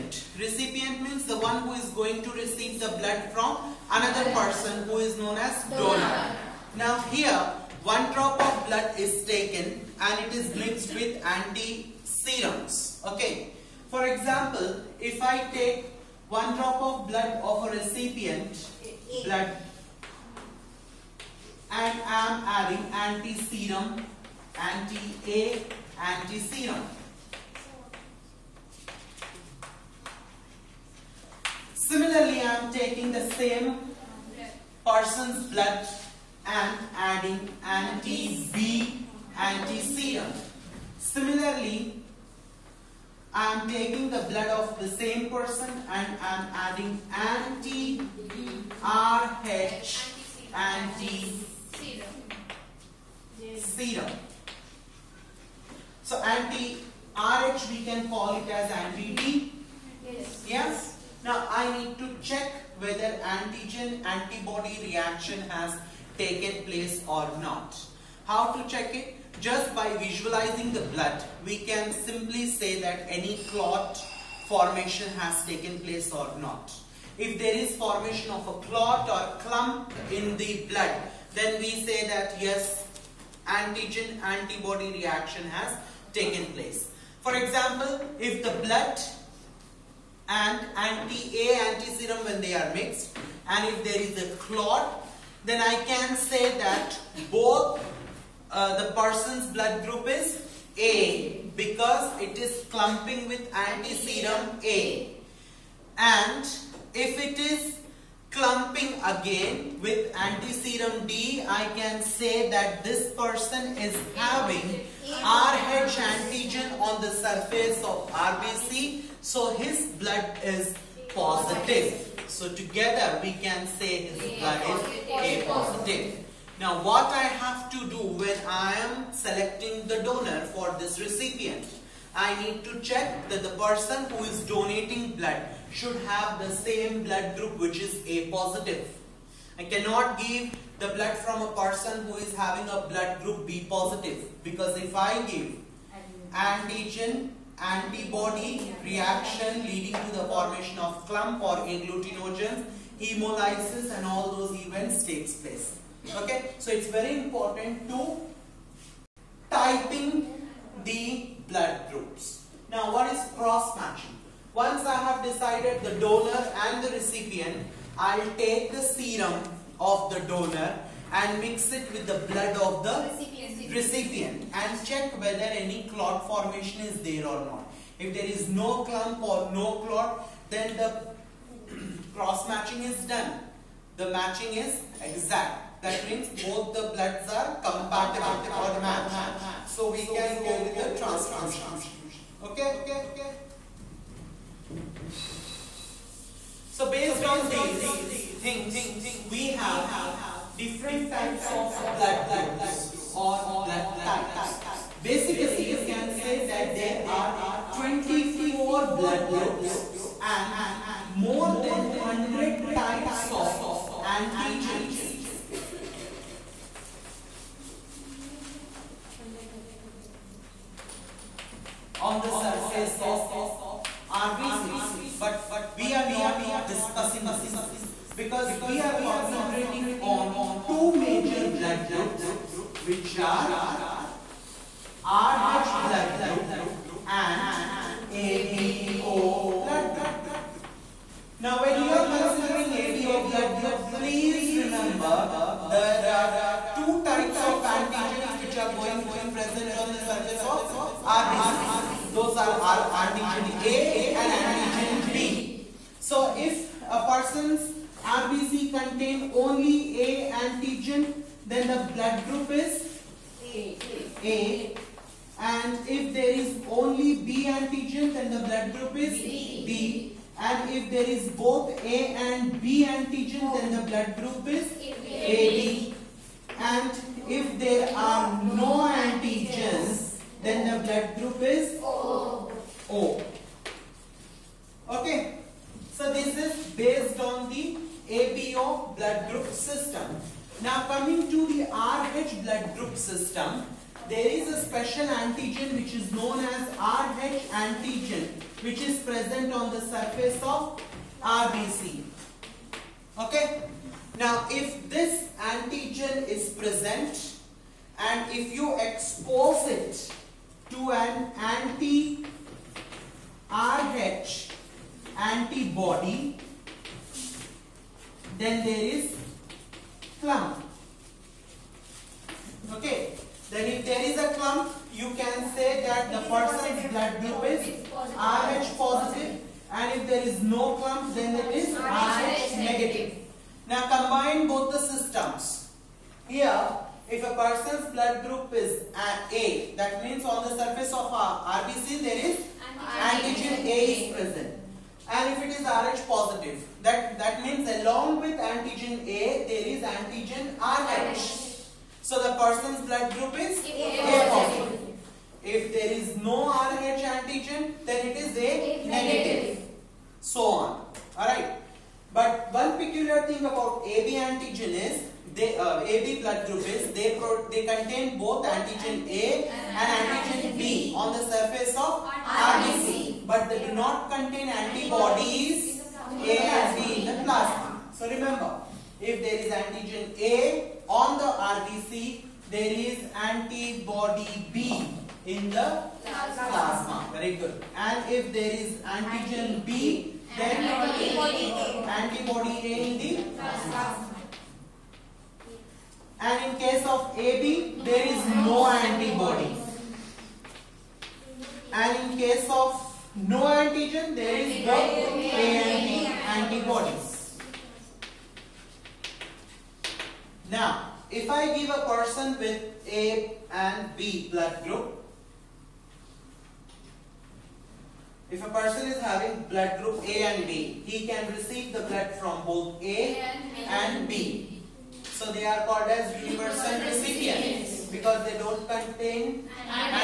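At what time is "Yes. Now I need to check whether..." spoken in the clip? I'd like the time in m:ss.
1:00.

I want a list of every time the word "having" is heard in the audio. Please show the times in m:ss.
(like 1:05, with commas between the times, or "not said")
1:54, 2:22, 6:59.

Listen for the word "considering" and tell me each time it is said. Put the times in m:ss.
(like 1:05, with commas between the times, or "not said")
4:02.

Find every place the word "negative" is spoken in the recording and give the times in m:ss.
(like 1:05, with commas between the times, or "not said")
5:32, 5:58.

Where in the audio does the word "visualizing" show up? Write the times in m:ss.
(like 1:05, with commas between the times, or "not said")
1:09.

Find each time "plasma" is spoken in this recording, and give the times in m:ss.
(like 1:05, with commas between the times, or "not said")
6:17, 6:26.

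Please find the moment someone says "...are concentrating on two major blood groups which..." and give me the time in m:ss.
3:48.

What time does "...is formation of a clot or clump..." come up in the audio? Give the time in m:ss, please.
1:17.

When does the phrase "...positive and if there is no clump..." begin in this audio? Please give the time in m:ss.
5:28.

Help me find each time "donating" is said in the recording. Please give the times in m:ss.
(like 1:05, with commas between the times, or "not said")
2:14.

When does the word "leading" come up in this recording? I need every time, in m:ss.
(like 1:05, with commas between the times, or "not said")
2:29.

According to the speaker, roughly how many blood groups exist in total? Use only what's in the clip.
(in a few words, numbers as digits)
24.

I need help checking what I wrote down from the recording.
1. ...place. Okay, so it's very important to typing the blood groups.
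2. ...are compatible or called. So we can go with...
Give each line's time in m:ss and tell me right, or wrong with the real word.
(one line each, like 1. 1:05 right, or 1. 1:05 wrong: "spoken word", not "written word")
1. 2:35 right
2. 3:07 wrong: "matched", not "called".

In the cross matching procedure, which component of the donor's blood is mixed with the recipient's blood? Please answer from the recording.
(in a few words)
Serum.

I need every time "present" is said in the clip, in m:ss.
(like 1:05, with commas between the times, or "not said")
4:09, 4:58, 5:06, 5:44.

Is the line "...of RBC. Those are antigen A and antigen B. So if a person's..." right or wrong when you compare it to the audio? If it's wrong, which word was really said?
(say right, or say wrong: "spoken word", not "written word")
right.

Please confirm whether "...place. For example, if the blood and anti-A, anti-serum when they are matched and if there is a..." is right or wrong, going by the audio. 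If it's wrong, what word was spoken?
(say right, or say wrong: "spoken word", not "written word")
wrong: "mixed", not "matched".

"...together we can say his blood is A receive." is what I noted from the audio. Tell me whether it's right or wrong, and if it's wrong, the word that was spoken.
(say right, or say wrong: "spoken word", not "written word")
wrong: "positive", not "receive".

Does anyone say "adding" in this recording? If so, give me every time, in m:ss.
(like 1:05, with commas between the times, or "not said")
0:22, 0:36, 0:46.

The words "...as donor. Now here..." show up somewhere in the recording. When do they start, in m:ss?
0:05.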